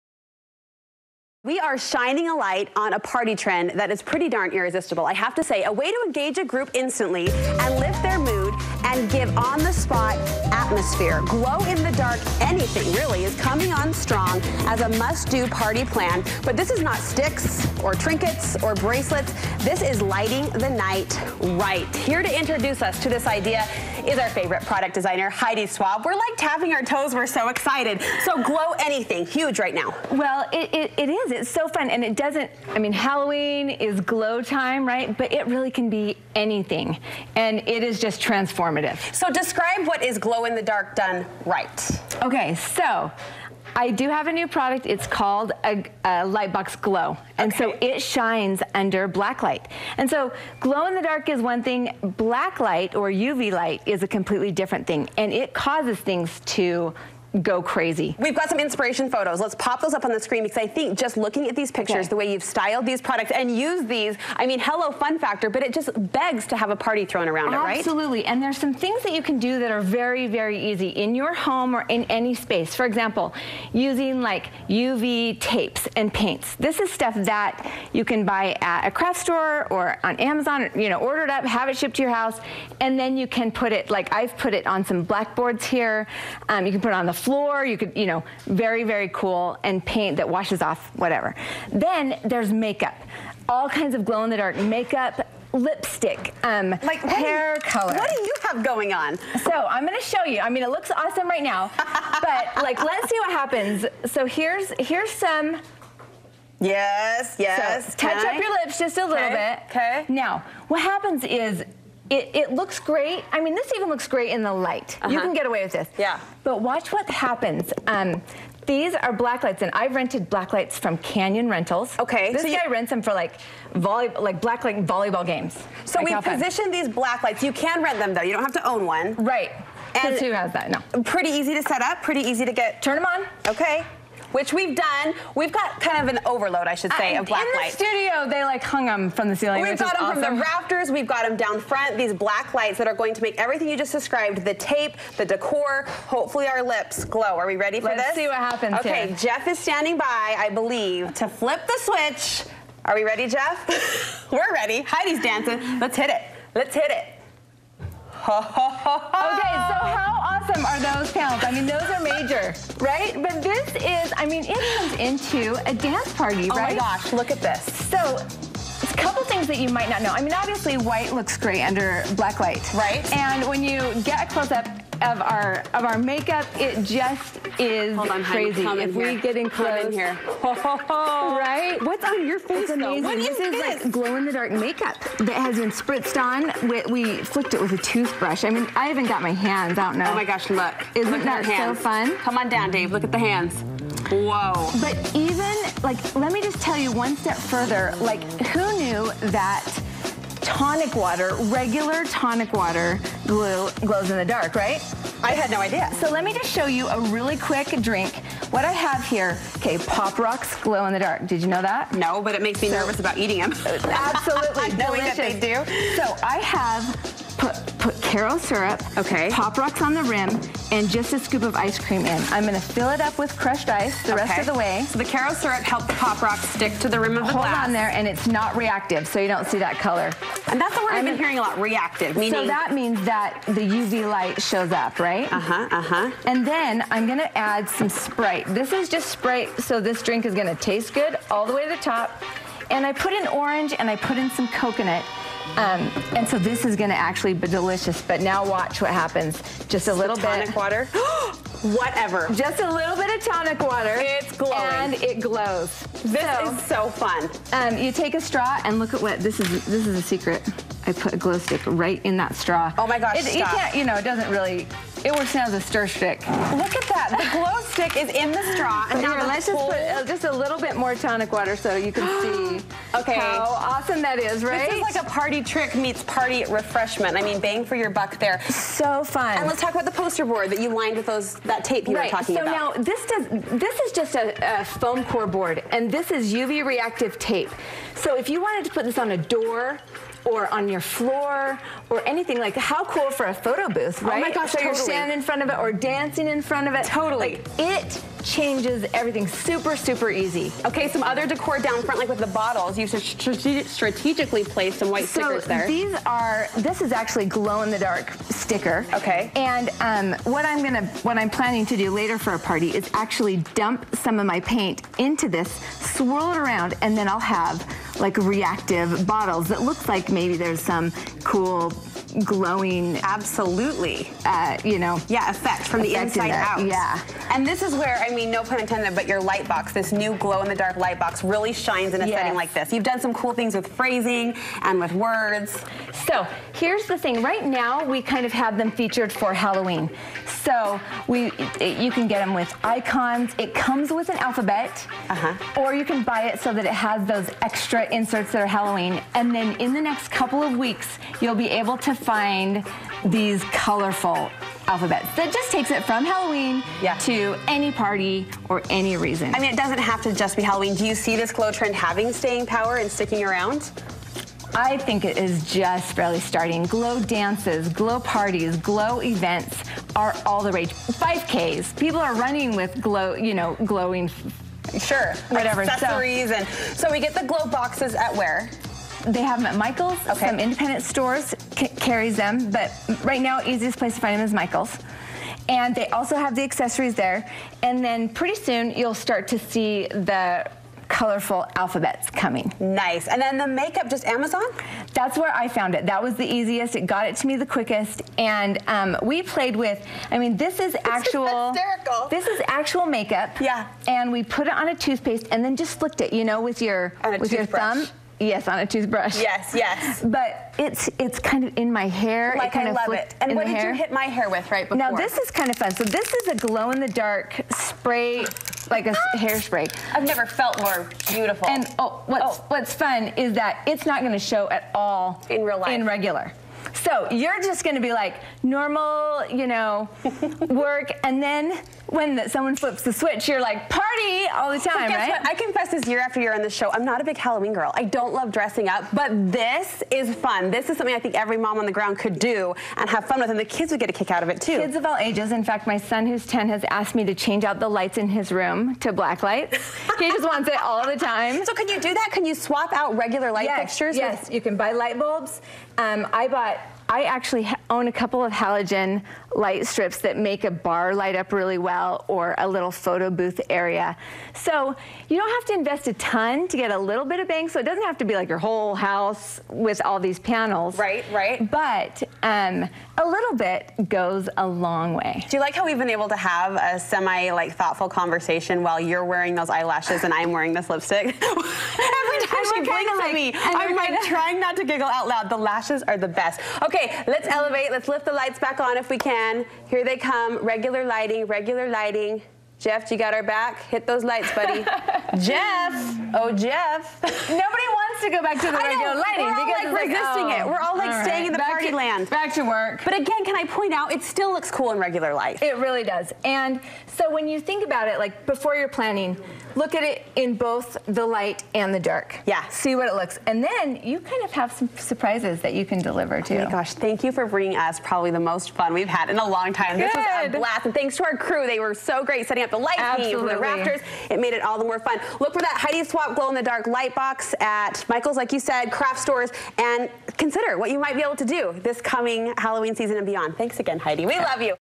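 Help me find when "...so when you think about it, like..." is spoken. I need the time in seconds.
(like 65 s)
506 s.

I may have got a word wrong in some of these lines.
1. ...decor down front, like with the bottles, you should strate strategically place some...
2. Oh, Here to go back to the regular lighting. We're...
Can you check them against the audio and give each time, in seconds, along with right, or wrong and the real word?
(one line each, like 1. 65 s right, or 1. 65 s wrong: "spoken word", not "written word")
1. 301 s right
2. 496 s wrong: "Jeff", not "Here".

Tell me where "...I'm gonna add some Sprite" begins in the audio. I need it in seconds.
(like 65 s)
236 s.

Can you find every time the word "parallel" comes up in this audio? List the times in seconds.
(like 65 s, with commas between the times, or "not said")
not said.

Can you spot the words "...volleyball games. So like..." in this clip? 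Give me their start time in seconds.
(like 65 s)
124 s.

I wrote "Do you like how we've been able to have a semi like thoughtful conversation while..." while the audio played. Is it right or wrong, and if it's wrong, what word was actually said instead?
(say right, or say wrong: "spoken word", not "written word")
right.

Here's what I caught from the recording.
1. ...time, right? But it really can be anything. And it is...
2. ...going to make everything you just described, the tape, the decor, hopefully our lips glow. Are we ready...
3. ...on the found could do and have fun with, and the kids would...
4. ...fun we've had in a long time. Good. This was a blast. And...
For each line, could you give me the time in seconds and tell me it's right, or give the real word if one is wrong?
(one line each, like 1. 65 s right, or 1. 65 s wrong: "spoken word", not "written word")
1. 34 s right
2. 142 s right
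3. 441 s wrong: "ground", not "found"
4. 518 s right.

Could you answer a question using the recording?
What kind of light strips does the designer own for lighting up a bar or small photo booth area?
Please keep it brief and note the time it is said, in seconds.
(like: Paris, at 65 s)
Halogen light strips, at 458 s.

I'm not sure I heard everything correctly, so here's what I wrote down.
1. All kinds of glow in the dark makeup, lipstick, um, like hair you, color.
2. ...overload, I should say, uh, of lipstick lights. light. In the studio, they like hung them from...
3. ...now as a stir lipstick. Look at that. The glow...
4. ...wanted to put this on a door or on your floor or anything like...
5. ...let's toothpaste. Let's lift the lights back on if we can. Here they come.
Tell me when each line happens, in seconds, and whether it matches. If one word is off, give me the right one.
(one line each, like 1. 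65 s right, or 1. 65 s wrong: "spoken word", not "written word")
1. 93 s right
2. 136 s wrong: "black", not "lipstick"
3. 265 s wrong: "stick", not "lipstick"
4. 288 s right
5. 487 s wrong: "elevate", not "toothpaste".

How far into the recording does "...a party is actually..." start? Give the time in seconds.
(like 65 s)
312 s.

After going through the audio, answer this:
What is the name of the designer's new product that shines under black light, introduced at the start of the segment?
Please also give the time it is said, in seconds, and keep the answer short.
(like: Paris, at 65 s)
Lightbox Glow, at 46 s.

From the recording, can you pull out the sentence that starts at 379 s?
They have them at Michael's, okay.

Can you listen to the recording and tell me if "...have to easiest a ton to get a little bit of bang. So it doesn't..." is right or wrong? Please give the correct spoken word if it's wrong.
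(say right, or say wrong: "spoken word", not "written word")
wrong: "invest", not "easiest".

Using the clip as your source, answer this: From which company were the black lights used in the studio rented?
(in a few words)
Canyon Rentals.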